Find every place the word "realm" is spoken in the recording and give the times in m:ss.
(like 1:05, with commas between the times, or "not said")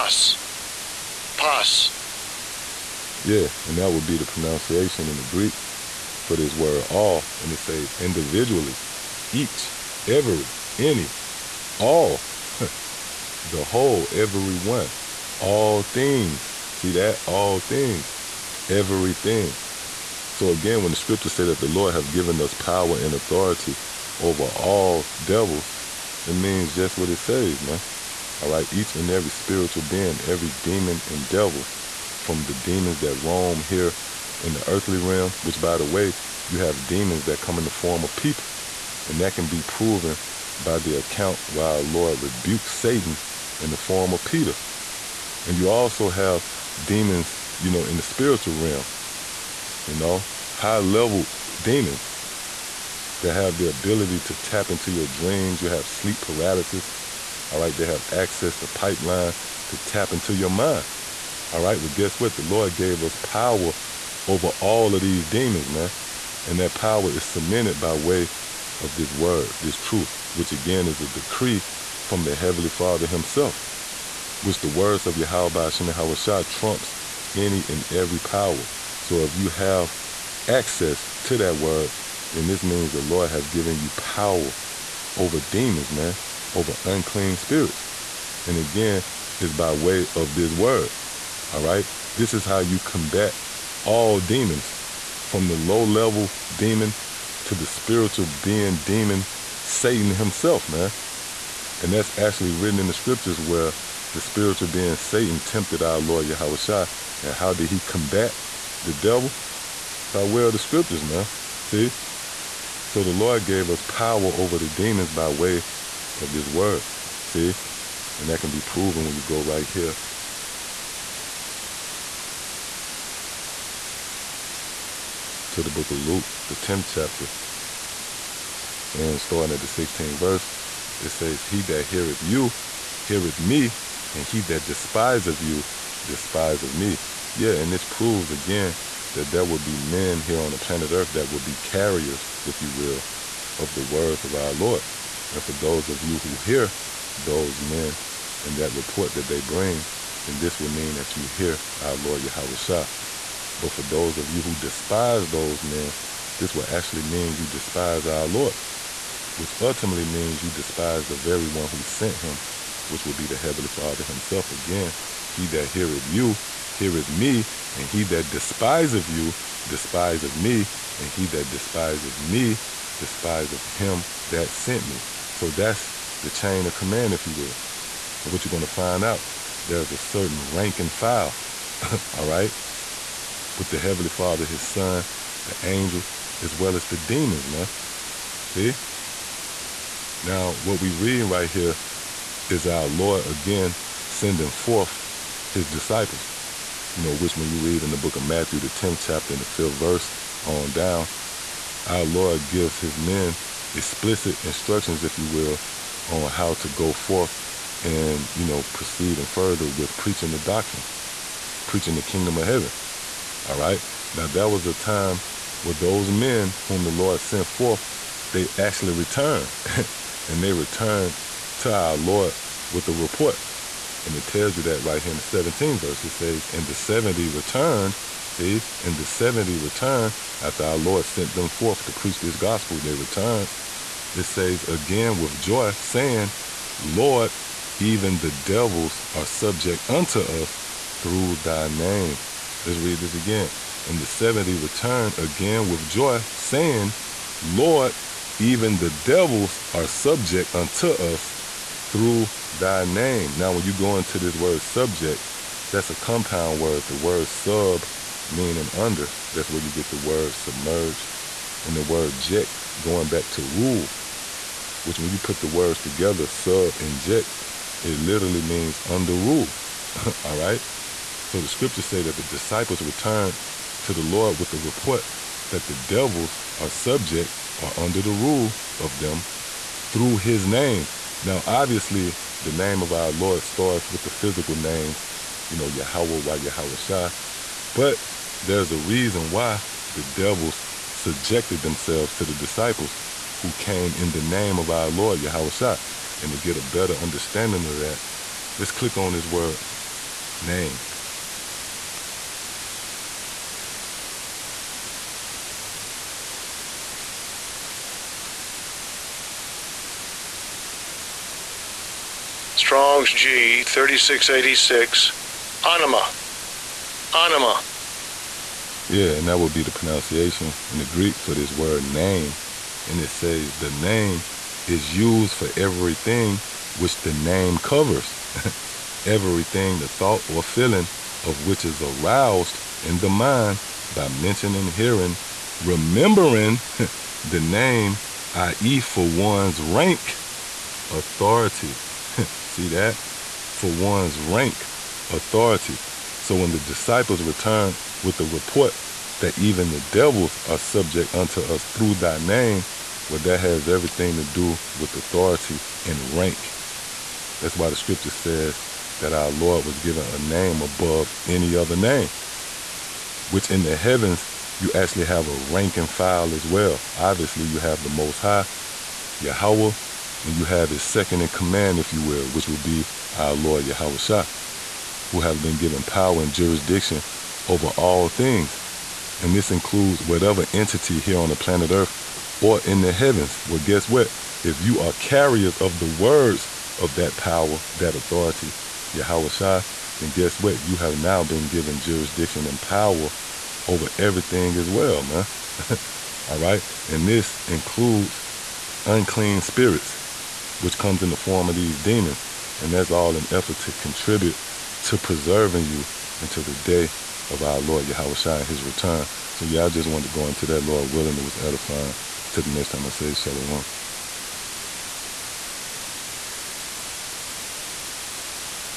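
0:34, 0:48.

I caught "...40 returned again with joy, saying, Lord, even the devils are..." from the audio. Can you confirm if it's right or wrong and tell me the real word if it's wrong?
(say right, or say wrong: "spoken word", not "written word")
wrong: "70", not "40".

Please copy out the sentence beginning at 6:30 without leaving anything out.
You have now been given jurisdiction and power over everything as well, man.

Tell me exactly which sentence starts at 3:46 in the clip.
It says, And the 70 returned.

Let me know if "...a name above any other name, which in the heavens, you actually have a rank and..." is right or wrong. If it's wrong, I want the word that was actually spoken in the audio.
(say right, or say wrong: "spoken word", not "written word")
right.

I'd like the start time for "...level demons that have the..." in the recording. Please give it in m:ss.
0:50.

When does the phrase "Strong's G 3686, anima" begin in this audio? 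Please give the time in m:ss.
5:12.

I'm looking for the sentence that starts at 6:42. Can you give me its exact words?
And that's all an effort to contribute to preserving you until the day of our Lord Yahweh Shai and his return.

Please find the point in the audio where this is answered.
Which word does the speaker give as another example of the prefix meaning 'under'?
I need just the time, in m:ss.
4:20.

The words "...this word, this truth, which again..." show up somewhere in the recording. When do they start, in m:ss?
1:08.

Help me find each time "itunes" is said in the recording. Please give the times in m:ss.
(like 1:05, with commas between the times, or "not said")
not said.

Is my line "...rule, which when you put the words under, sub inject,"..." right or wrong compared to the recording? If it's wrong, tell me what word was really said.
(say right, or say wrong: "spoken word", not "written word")
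wrong: "together", not "under".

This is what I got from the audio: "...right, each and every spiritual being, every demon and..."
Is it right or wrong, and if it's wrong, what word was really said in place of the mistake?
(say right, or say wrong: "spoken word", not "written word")
right.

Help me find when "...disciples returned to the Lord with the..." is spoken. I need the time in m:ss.
4:32.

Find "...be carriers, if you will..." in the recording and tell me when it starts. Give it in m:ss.
2:21.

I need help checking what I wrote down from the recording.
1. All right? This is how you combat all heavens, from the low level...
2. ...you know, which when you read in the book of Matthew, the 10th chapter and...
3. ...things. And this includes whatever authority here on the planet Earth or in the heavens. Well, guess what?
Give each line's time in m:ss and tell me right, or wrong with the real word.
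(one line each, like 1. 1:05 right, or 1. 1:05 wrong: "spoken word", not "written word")
1. 1:31 wrong: "demons", not "heavens"
2. 3:16 right
3. 6:18 wrong: "entity", not "authority".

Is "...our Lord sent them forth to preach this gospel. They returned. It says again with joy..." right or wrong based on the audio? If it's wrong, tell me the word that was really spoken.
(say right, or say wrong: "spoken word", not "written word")
right.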